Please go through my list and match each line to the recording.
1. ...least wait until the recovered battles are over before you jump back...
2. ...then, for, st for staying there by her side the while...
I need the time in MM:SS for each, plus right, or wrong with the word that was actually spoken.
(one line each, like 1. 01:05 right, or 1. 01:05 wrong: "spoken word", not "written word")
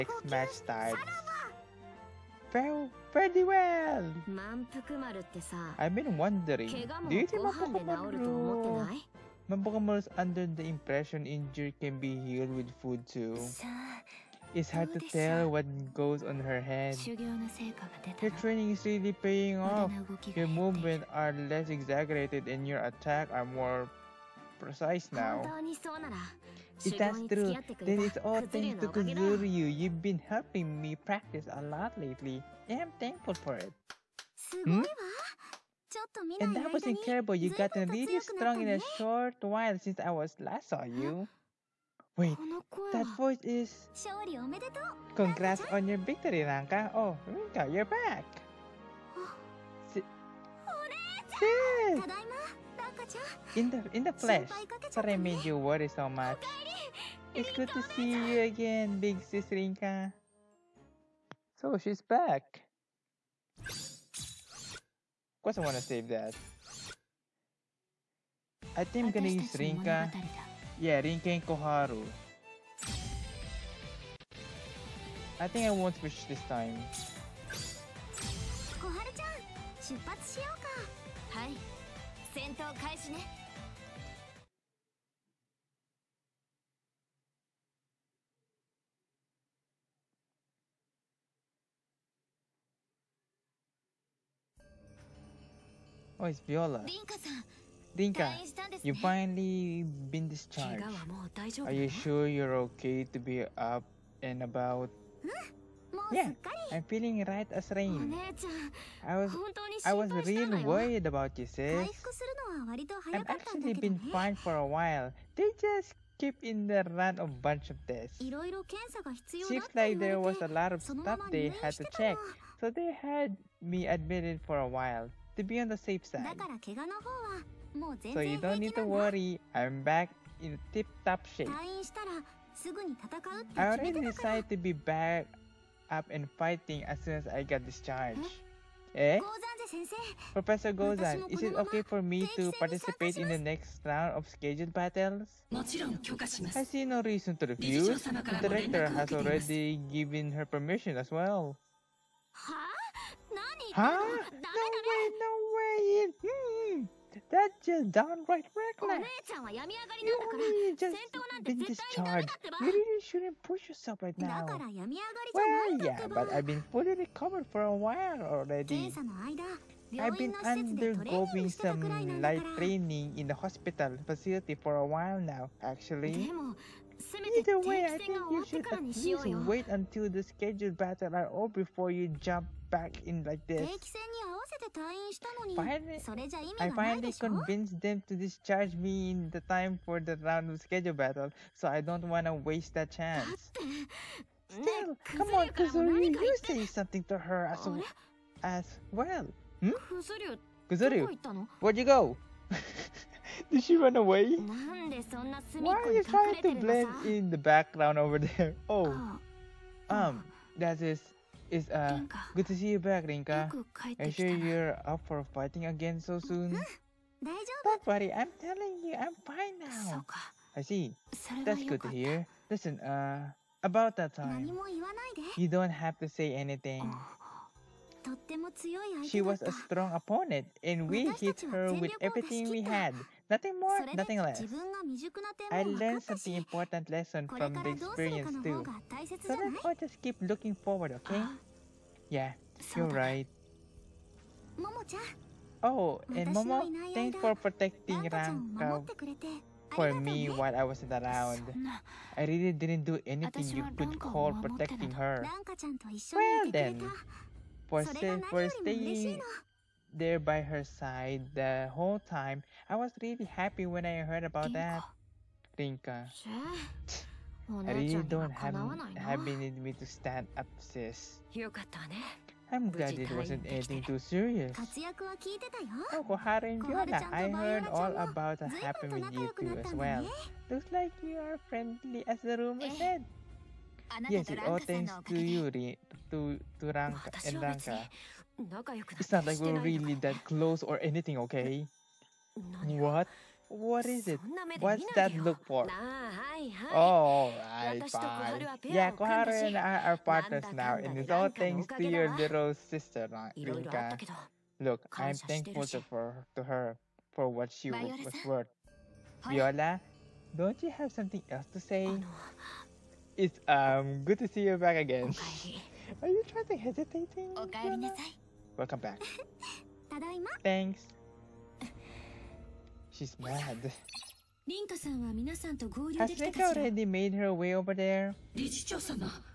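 1. 02:58 wrong: "scheduled", not "recovered"
2. 04:16 wrong: "whole", not "while".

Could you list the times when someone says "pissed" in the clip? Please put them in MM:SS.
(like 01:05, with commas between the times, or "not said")
not said.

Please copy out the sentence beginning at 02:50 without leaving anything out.
I've been undergoing some light training in the hospital facility for a while now, actually.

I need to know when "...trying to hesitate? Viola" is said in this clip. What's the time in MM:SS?
05:16.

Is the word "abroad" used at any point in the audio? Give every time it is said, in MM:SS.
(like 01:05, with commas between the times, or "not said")
not said.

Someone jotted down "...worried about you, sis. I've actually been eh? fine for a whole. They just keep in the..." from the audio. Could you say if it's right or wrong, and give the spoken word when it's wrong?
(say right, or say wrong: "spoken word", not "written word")
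wrong: "while", not "whole".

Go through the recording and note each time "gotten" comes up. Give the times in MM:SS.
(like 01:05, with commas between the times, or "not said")
00:37.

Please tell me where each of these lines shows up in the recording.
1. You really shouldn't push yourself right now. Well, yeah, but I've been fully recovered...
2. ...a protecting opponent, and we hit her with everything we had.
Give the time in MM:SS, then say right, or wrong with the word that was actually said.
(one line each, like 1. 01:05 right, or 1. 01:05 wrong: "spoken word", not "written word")
1. 02:42 right
2. 03:49 wrong: "strong", not "protecting".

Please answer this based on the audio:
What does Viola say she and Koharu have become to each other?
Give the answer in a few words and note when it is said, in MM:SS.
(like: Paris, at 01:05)
Partners, at 04:59.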